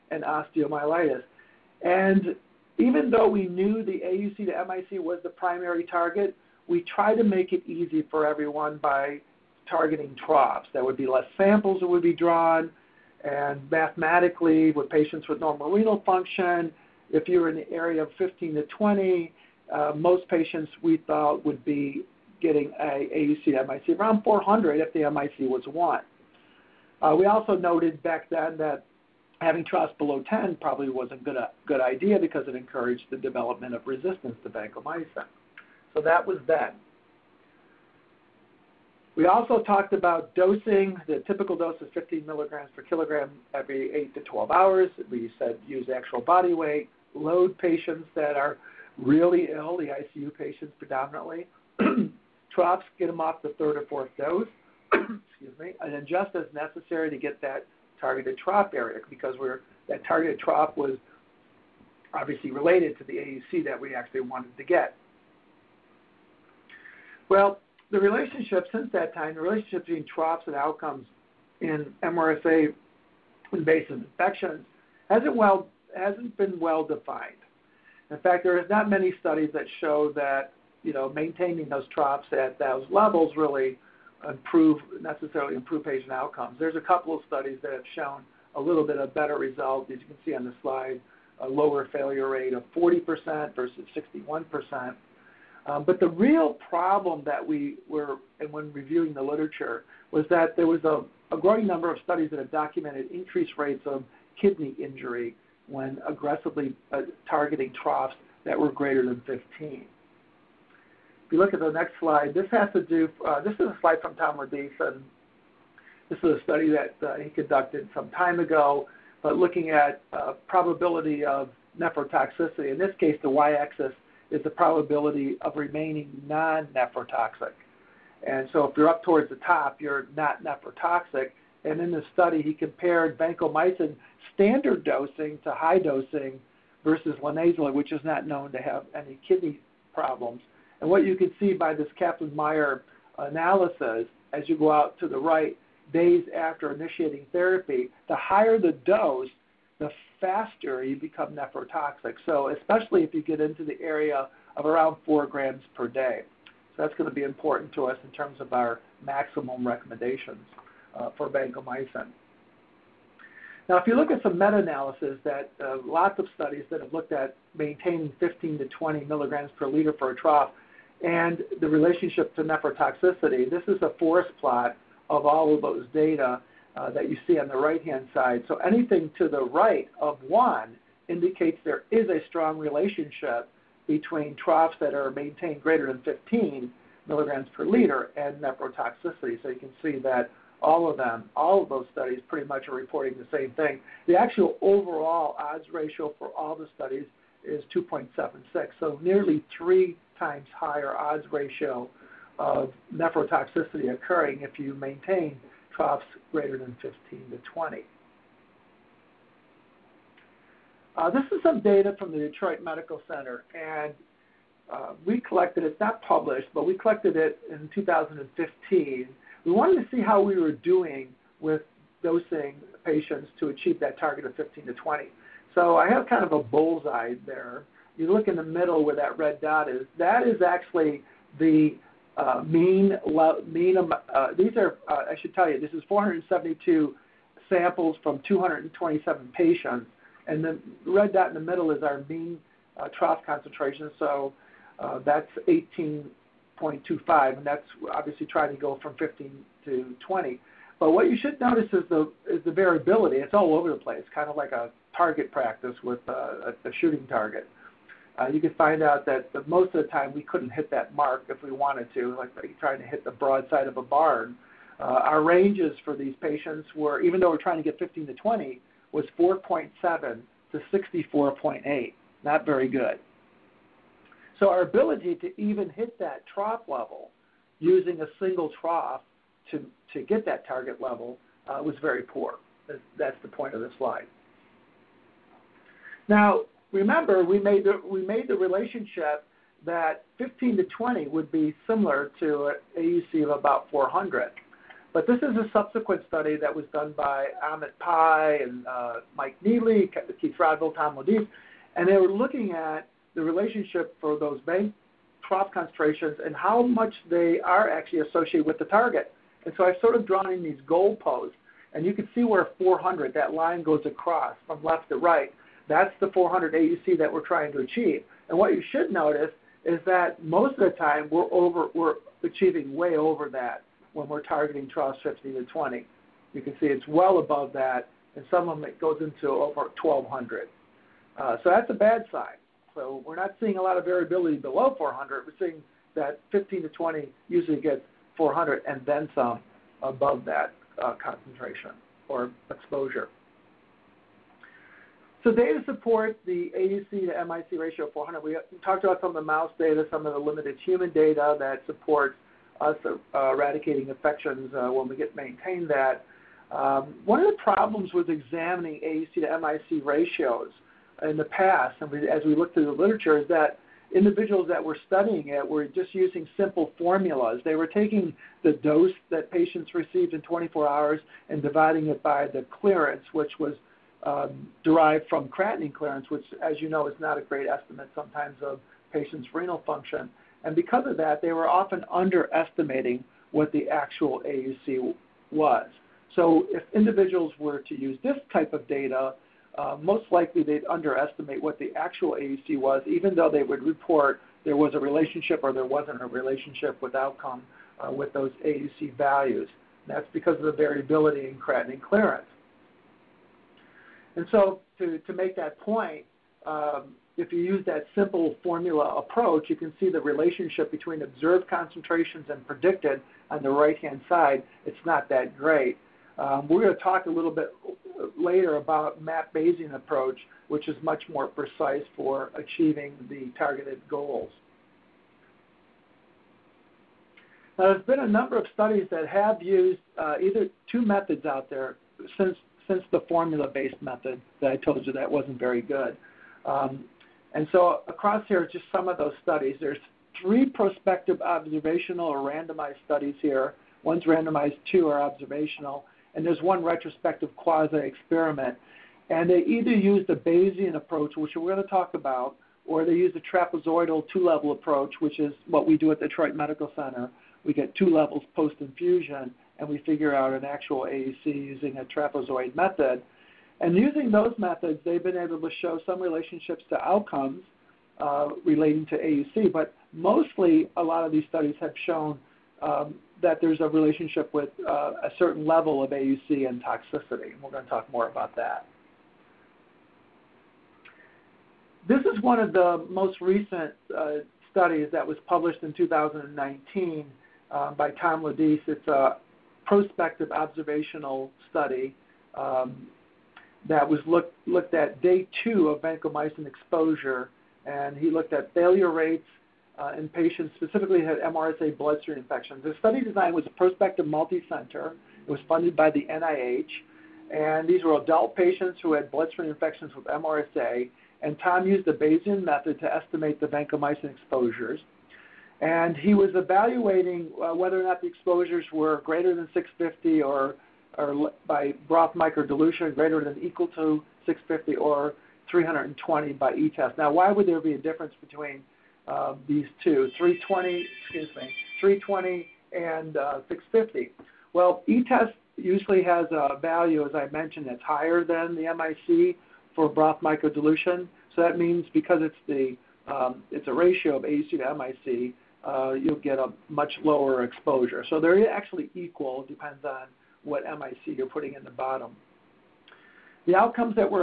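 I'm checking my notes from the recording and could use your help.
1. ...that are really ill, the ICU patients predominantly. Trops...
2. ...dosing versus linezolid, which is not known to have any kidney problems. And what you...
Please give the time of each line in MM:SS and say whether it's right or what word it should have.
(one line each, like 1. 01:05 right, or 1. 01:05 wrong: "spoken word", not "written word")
1. 00:48 right
2. 02:15 right.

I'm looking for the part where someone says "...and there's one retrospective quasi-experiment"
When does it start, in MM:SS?
07:26.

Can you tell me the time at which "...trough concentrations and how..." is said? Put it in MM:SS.
05:05.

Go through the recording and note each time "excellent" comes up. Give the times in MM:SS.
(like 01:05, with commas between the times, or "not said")
not said.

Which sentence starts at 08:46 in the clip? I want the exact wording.
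Now, why would there be a difference between uh, these two, 320, excuse me, 320 and uh, 650?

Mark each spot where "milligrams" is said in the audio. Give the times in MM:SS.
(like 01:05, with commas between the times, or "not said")
00:42, 02:49, 03:07.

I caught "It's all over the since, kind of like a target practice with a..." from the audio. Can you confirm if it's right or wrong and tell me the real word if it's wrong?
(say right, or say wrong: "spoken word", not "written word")
wrong: "place", not "since".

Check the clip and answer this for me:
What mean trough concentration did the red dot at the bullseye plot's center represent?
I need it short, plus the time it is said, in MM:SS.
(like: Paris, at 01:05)
18.25, at 04:05.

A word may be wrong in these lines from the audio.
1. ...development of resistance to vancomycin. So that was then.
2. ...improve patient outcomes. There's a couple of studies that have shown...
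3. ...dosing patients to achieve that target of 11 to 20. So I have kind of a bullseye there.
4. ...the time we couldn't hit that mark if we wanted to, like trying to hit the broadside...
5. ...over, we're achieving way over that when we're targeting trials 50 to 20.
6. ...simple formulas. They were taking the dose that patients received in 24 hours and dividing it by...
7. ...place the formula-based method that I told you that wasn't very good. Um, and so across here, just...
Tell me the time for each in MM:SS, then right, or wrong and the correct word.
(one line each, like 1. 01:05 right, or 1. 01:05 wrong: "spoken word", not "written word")
1. 00:33 right
2. 01:25 right
3. 03:42 wrong: "15", not "11"
4. 04:19 right
5. 05:21 right
6. 06:06 right
7. 07:12 wrong: "since", not "place".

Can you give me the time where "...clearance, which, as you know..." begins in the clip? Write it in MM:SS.
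06:15.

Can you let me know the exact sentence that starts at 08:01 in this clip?
This is one of the most recent uh, studies that was published in 2019 uh, by Tom Lodise.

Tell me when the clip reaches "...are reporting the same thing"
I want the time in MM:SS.
03:12.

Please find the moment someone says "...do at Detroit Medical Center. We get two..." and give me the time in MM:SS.
07:35.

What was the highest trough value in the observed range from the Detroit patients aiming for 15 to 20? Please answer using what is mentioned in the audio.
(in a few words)
64.8.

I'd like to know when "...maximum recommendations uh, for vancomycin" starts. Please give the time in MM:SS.
02:39.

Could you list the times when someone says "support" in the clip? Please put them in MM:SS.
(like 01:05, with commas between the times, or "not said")
05:45, 05:51.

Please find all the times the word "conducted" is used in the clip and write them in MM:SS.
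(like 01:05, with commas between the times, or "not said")
01:57.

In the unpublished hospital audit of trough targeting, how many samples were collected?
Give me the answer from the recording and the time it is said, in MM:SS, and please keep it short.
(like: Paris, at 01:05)
472, at 03:55.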